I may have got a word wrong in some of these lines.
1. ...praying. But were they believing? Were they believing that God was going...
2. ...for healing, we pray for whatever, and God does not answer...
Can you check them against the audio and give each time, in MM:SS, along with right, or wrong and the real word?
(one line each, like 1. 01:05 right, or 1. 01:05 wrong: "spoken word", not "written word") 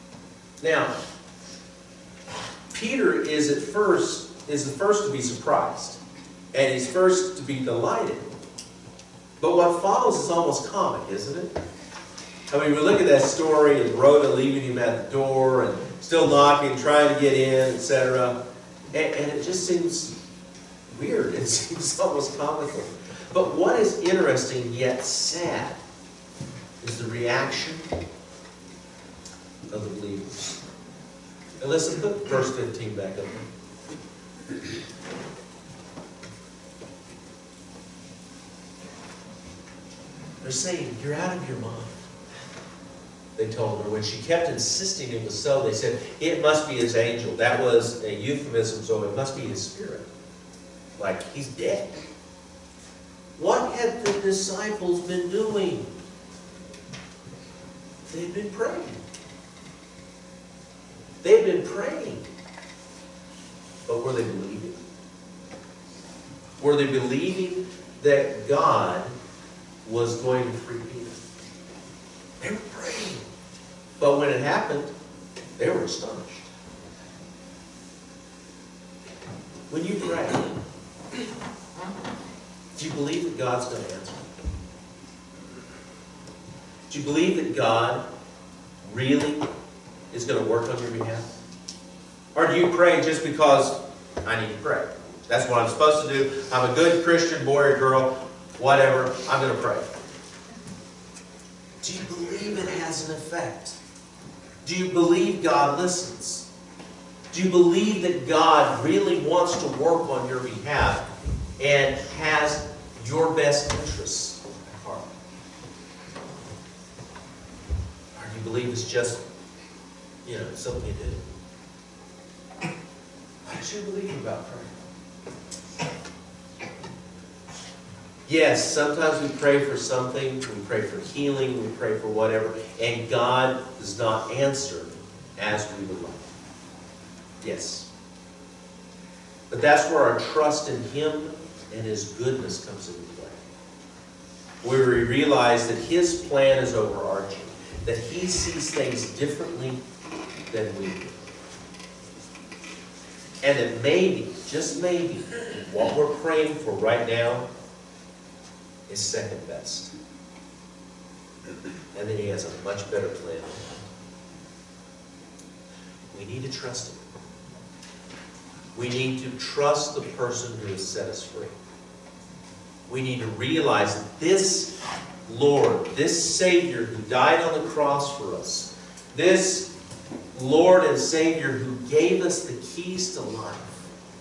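1. 01:01 right
2. 02:10 right.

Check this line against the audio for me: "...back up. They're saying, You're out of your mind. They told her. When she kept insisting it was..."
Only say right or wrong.
right.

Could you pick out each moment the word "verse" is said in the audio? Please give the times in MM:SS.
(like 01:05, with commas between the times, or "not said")
00:32.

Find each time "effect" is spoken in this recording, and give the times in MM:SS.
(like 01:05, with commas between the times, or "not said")
01:43.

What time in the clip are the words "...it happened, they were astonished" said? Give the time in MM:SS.
01:14.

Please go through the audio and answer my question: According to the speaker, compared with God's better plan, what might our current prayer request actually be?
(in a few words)
second best.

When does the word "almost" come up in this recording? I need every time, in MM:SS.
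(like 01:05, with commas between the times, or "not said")
00:10, 00:21.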